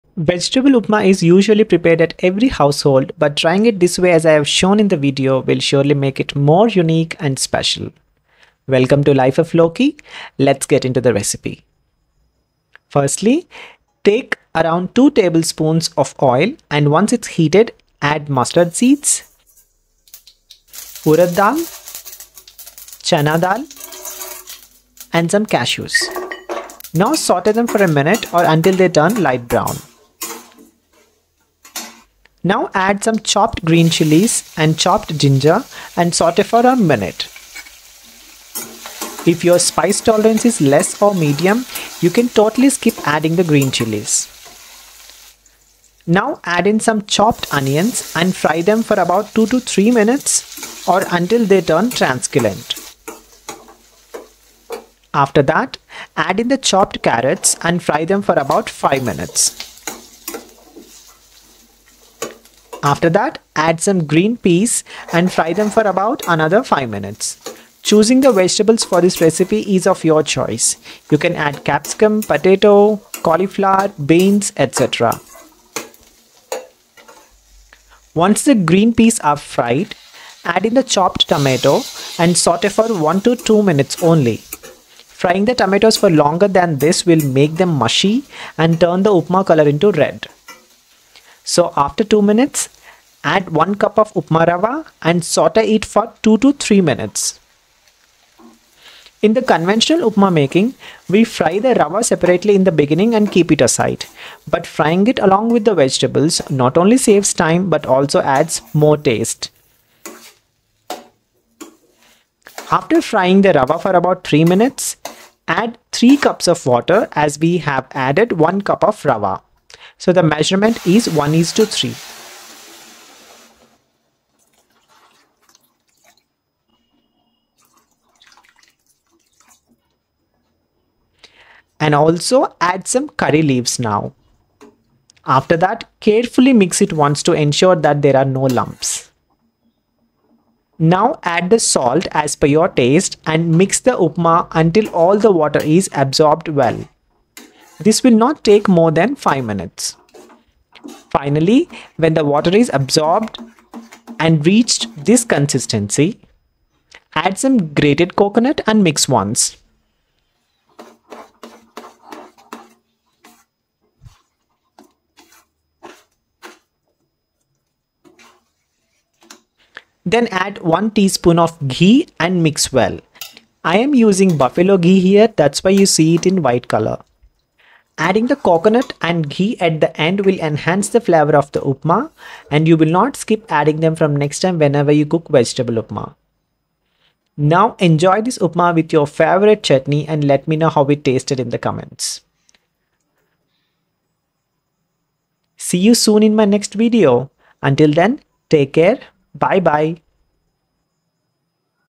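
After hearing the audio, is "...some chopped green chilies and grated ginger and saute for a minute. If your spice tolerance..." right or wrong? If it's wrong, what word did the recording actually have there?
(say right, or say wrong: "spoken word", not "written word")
wrong: "chopped", not "grated".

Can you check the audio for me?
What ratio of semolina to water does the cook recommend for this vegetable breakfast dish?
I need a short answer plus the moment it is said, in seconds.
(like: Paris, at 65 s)
1 to 3, at 121 s.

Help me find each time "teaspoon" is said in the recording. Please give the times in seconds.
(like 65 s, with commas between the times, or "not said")
170 s.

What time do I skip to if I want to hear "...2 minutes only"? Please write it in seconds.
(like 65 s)
83 s.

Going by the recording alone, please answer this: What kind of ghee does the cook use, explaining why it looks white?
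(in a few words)
Buffalo ghee.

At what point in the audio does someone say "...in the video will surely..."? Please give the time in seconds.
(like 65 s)
4 s.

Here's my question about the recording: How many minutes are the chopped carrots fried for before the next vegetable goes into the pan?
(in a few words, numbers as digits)
5 minutes.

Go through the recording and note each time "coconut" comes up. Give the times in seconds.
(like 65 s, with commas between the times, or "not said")
158 s, 178 s.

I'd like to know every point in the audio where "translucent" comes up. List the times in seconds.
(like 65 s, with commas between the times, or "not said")
51 s.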